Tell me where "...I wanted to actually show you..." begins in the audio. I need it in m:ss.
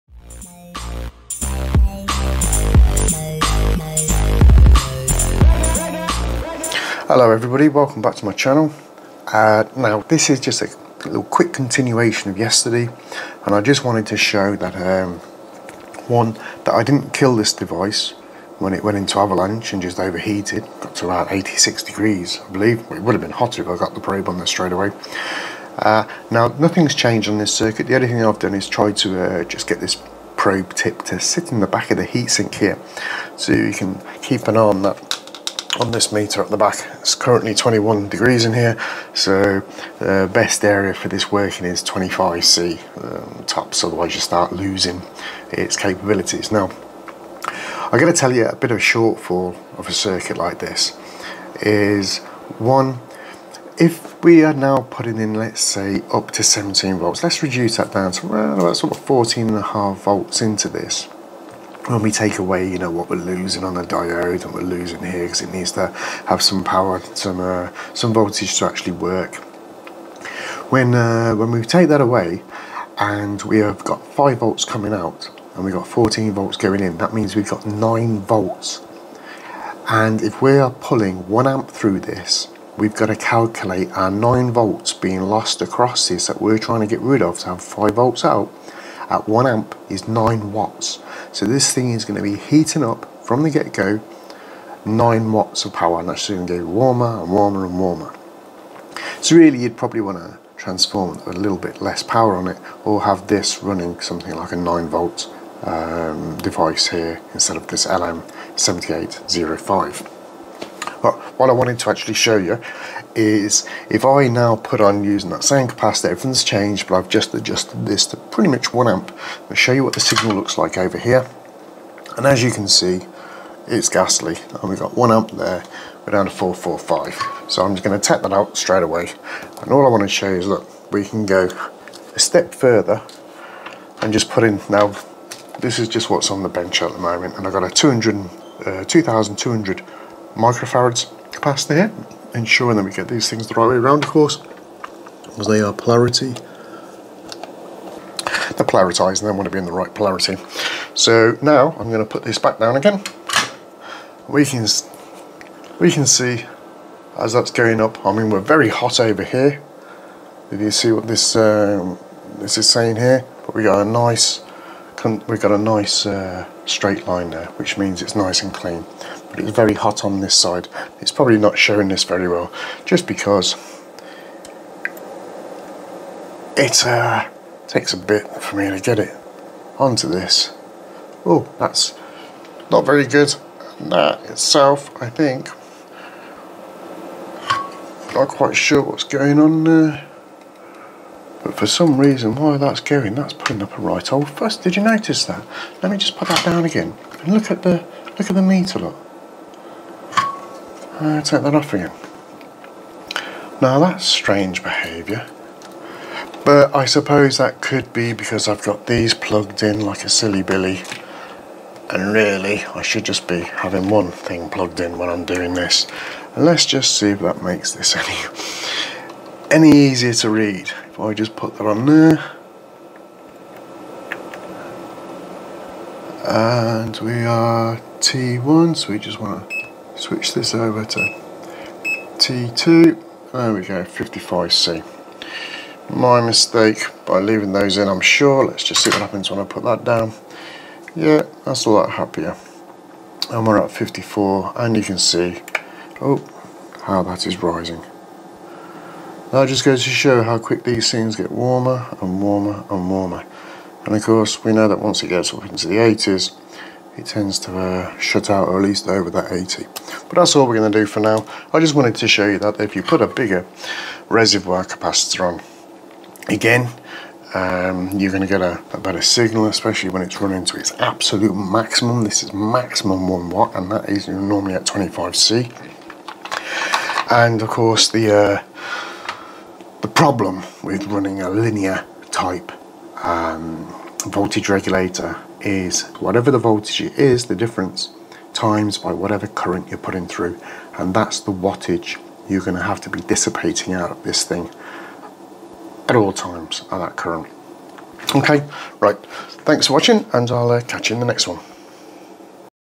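1:51.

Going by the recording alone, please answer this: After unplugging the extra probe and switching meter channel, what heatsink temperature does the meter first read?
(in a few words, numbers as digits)
55C.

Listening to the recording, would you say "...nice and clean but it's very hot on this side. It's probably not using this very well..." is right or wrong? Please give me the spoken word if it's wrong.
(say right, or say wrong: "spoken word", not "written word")
wrong: "showing", not "using".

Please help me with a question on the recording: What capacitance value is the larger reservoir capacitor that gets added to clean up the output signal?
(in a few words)
2200 microfarads.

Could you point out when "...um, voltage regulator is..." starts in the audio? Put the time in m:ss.
4:43.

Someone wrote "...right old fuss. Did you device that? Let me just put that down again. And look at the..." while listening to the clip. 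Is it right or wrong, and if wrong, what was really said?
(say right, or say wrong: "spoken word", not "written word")
wrong: "notice", not "device".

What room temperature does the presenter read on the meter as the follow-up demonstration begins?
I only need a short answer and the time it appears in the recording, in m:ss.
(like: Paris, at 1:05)
21 degrees, at 0:37.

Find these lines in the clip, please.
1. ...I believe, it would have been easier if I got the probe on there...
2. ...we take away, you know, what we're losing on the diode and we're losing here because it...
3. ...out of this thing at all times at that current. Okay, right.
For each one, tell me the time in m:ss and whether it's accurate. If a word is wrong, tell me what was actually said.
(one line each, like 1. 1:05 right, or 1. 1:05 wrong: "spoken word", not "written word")
1. 0:22 wrong: "hotter", not "easier"
2. 1:02 right
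3. 4:53 right.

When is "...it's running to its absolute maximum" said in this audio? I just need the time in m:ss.
4:30.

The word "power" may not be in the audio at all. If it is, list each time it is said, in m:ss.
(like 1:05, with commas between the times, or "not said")
1:06, 1:35, 1:42.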